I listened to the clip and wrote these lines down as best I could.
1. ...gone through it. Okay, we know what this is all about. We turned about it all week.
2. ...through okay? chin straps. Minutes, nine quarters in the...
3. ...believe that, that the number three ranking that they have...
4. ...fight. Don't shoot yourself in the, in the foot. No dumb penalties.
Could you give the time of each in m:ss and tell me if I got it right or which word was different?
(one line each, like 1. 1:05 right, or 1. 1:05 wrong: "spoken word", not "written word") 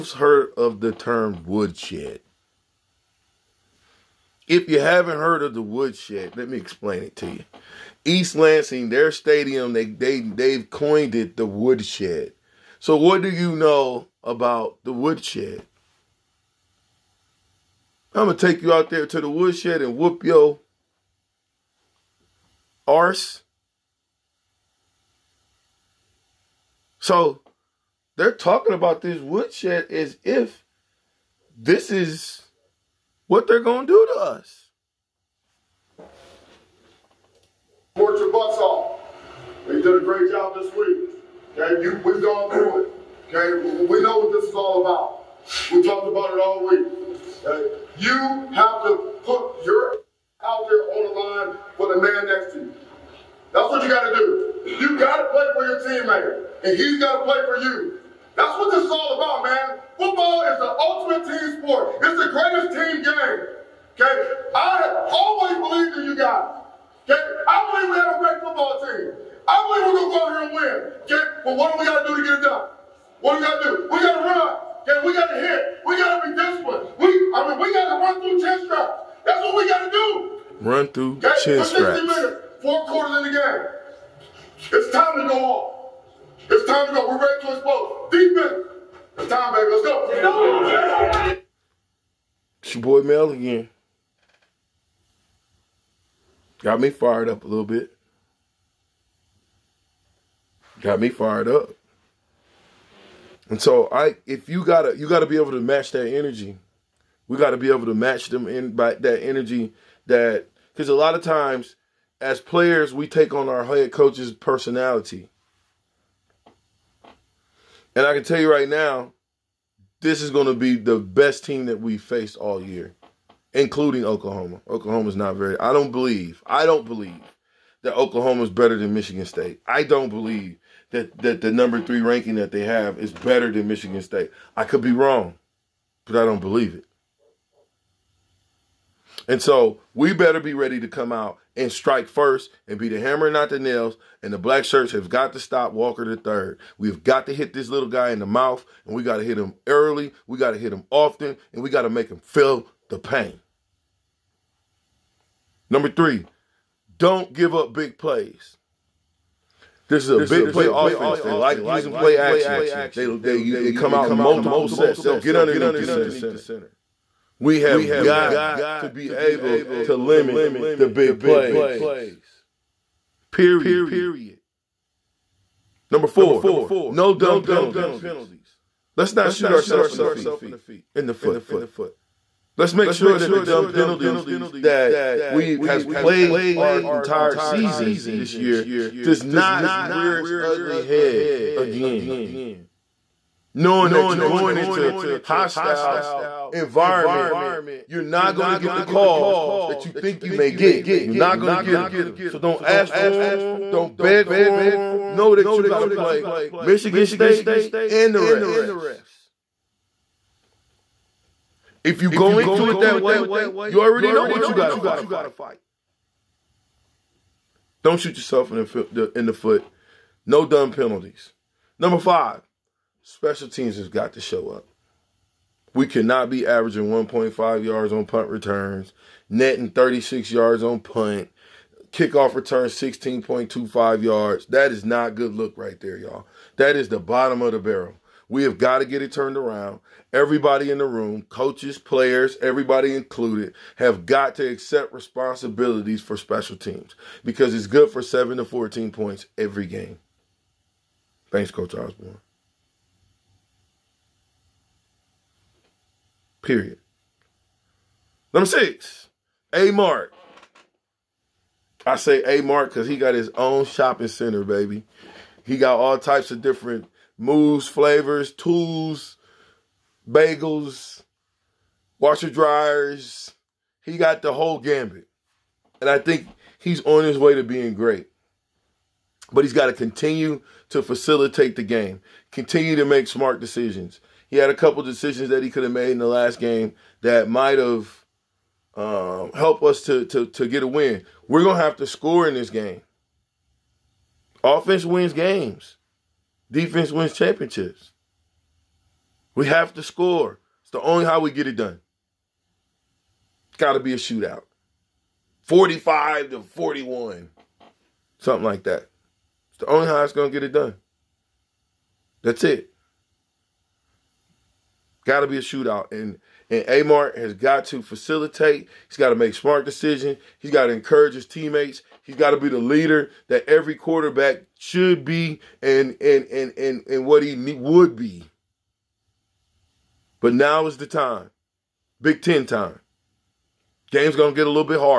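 1. 0:42 wrong: "talked", not "turned"
2. 1:20 wrong: "four", not "nine"
3. 2:10 right
4. 3:34 right.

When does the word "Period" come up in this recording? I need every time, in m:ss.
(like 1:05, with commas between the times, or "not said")
2:53, 4:16.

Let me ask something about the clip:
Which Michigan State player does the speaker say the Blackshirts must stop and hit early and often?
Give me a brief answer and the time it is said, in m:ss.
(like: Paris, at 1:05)
Walker the third, at 2:25.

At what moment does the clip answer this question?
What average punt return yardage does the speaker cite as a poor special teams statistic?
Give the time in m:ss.
3:46.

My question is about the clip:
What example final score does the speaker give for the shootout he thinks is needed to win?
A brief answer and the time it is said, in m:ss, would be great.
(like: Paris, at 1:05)
45 to 41, at 5:05.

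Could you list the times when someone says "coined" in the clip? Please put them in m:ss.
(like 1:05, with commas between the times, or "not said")
0:10.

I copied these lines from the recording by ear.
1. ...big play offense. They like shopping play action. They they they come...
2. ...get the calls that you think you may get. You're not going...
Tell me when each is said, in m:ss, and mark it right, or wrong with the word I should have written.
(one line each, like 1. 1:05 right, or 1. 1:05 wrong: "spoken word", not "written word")
1. 2:40 wrong: "using", not "shopping"
2. 3:18 right.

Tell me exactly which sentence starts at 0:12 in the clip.
So what do you know about the woodshed?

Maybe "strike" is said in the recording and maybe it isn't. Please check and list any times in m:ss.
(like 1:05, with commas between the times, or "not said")
2:21.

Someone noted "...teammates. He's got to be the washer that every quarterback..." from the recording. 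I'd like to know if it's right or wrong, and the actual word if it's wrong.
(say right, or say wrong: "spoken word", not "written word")
wrong: "leader", not "washer".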